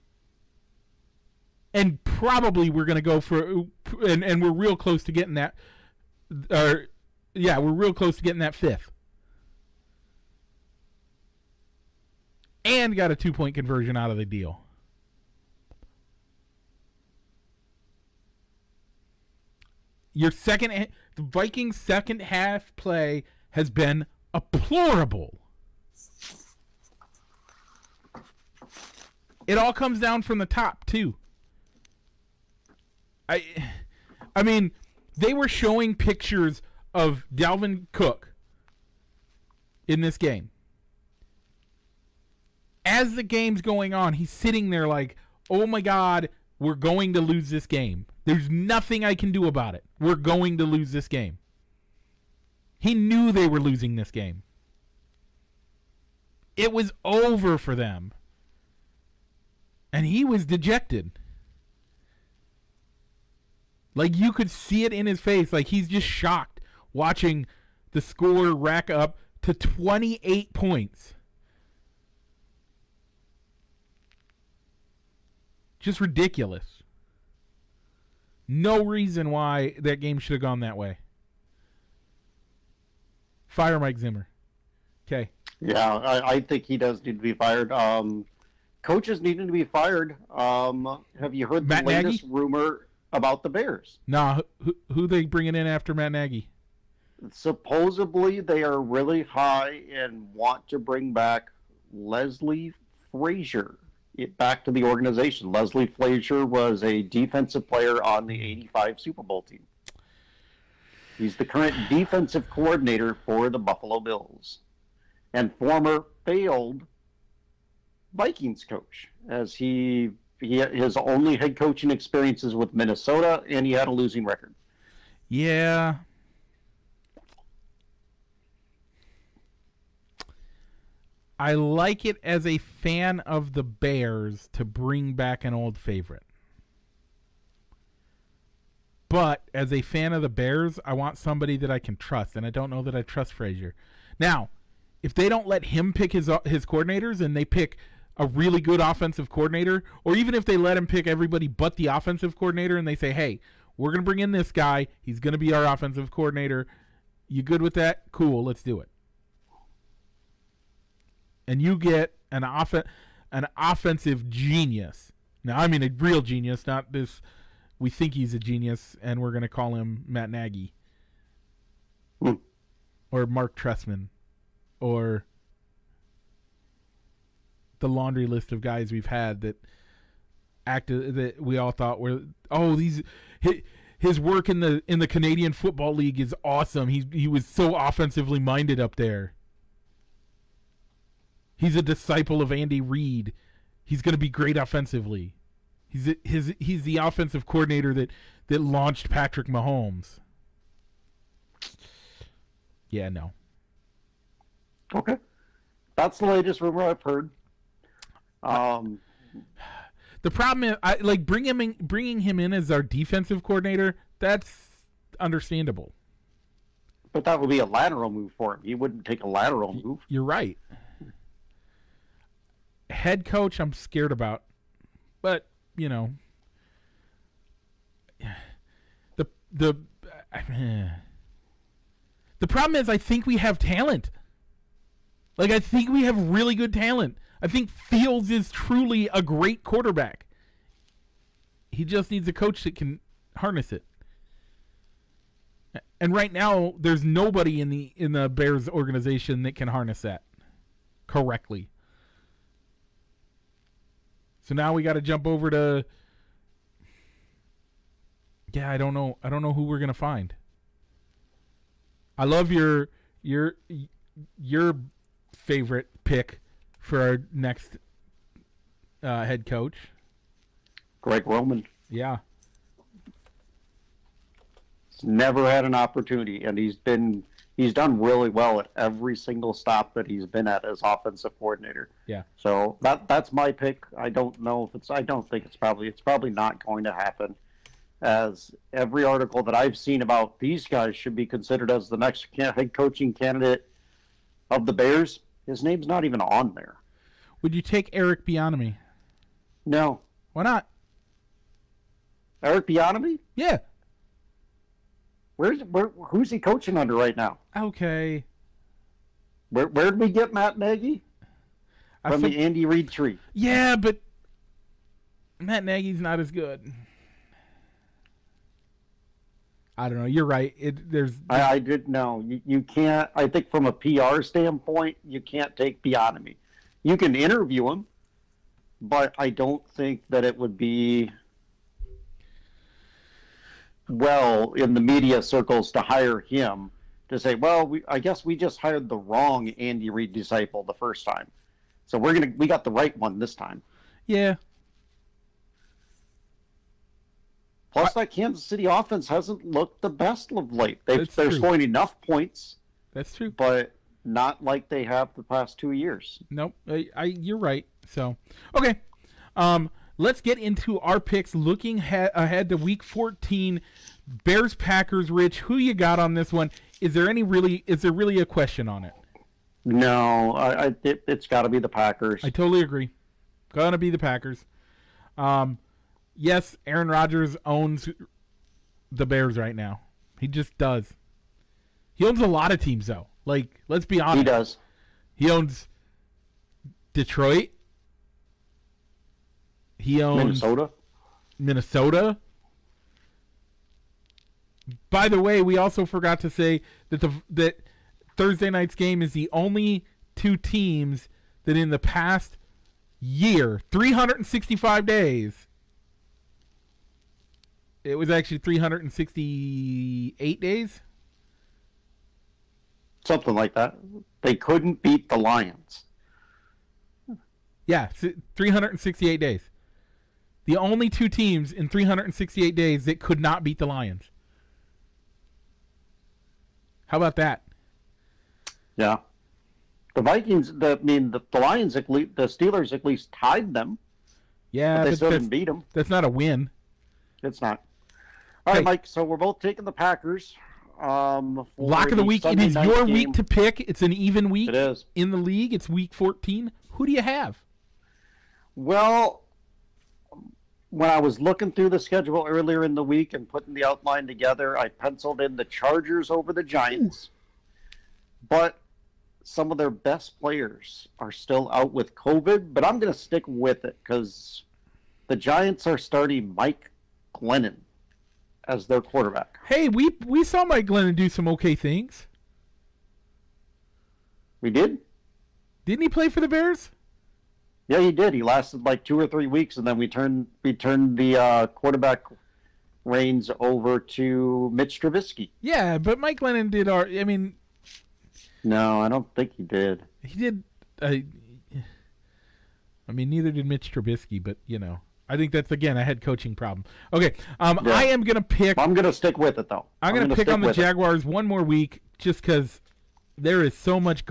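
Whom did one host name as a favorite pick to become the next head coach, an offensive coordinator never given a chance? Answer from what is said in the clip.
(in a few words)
Greg Roman.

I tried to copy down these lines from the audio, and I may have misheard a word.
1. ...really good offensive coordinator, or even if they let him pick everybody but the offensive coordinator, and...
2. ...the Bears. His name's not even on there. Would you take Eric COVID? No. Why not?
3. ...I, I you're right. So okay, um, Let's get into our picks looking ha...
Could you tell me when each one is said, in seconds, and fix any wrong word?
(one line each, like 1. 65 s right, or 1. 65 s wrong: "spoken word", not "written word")
1. 148 s right
2. 294 s wrong: "Bieniemy", not "COVID"
3. 356 s right.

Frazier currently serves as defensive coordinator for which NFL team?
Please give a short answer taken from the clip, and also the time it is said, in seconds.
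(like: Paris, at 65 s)
Buffalo Bills, at 113 s.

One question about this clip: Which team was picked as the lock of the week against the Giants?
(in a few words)
Chargers.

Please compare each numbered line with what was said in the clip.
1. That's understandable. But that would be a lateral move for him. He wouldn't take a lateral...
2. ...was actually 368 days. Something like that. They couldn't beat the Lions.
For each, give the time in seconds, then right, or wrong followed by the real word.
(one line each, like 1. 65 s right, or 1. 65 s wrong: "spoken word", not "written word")
1. 214 s right
2. 407 s right.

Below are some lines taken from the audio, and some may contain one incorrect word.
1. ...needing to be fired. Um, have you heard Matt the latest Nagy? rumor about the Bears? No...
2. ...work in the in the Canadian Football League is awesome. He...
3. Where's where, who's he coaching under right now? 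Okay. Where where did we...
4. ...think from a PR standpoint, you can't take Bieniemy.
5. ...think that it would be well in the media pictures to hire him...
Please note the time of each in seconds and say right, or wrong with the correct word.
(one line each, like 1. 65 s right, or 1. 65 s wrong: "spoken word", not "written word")
1. 89 s right
2. 184 s right
3. 305 s right
4. 323 s right
5. 329 s wrong: "circles", not "pictures".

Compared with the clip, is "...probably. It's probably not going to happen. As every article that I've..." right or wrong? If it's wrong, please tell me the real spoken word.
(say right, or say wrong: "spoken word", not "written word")
right.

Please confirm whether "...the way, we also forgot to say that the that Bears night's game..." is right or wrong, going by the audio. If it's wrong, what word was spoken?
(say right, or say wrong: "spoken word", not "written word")
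wrong: "Thursday", not "Bears".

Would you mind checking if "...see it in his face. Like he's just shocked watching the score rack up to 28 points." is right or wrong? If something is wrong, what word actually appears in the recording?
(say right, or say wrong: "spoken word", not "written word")
right.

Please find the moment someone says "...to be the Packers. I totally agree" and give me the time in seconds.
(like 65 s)
371 s.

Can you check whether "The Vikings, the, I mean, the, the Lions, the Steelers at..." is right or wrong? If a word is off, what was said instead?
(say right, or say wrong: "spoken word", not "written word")
right.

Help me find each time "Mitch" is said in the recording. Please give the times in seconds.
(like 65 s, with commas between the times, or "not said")
484 s, 493 s.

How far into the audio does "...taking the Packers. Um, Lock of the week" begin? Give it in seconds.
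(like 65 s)
439 s.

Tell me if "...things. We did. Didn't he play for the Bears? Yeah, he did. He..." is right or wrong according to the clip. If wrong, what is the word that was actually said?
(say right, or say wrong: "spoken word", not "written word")
right.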